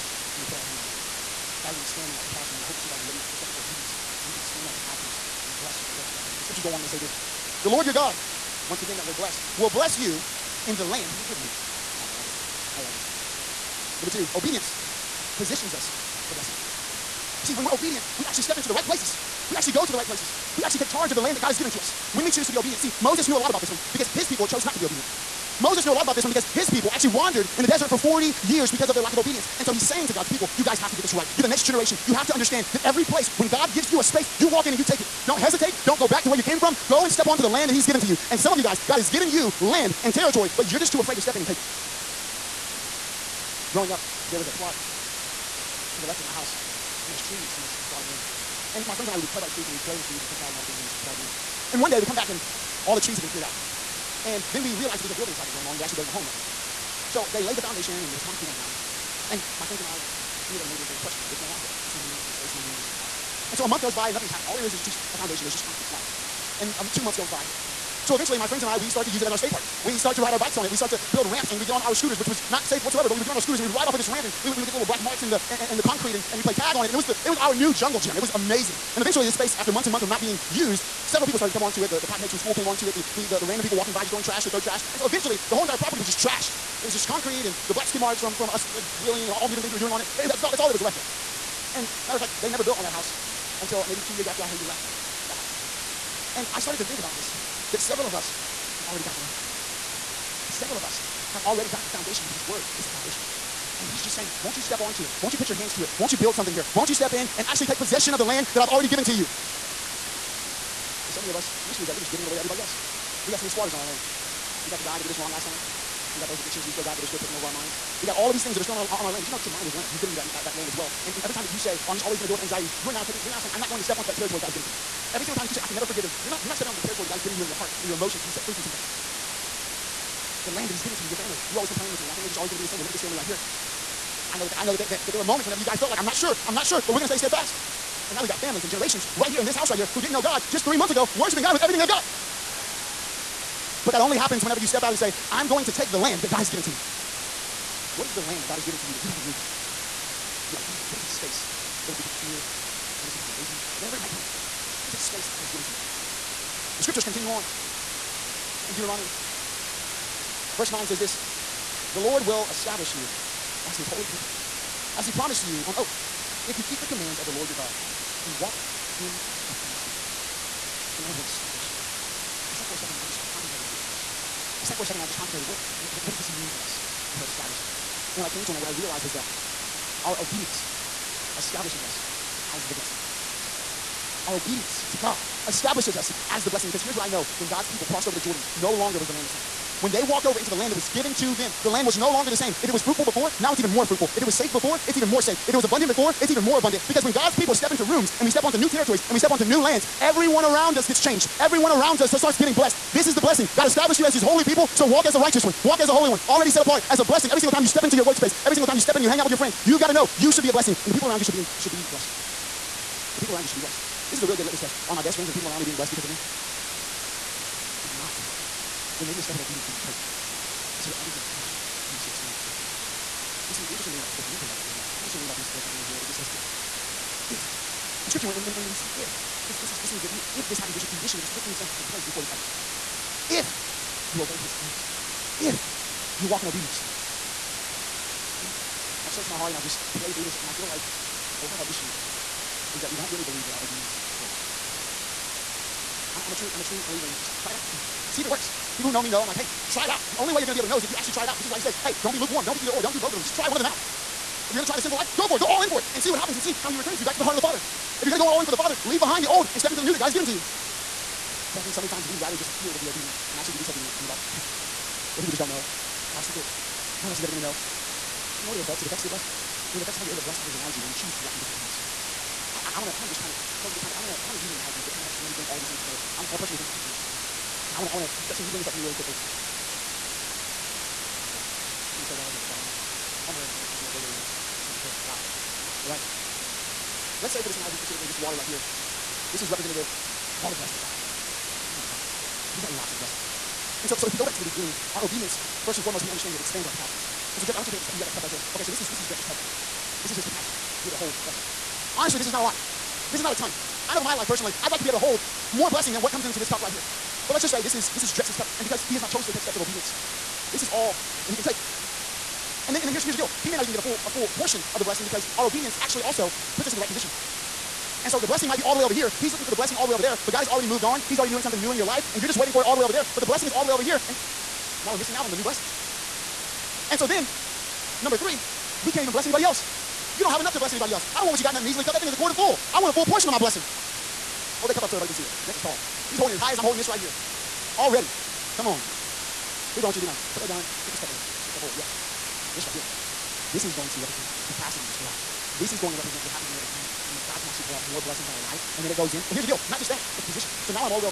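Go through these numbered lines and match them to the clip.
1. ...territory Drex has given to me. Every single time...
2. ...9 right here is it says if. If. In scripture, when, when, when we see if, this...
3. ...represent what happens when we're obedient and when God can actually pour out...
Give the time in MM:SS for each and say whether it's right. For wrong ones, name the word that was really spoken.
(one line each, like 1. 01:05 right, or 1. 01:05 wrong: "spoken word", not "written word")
1. 02:04 wrong: "God", not "Drex"
2. 03:45 right
3. 05:45 right.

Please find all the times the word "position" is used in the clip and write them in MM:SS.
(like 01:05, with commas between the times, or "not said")
00:15, 05:16, 05:50.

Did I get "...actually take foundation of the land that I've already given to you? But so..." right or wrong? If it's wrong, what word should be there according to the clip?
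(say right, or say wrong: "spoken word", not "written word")
wrong: "possession", not "foundation".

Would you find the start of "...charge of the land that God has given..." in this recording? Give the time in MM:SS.
00:20.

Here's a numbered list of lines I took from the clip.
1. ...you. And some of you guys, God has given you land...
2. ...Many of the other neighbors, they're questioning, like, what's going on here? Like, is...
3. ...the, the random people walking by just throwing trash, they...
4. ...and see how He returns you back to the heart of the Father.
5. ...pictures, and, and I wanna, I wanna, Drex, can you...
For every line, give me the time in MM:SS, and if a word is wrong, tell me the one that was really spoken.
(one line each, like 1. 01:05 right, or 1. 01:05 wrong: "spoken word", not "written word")
1. 00:38 right
2. 01:00 right
3. 01:23 right
4. 04:16 right
5. 04:36 right.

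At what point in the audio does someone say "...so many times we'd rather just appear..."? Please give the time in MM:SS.
04:21.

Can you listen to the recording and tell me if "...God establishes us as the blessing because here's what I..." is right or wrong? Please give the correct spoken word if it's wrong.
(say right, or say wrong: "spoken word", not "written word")
right.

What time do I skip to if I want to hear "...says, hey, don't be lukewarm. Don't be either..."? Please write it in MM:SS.
04:11.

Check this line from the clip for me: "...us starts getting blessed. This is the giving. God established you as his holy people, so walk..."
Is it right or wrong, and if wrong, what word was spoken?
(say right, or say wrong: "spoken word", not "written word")
wrong: "blessing", not "giving".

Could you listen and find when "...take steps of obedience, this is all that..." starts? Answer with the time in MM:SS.
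05:09.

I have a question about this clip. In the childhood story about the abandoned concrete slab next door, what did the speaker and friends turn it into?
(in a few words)
Skate park.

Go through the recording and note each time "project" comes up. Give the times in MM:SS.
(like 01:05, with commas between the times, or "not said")
00:55.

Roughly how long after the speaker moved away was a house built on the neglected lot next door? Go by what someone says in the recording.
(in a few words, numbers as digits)
2 years.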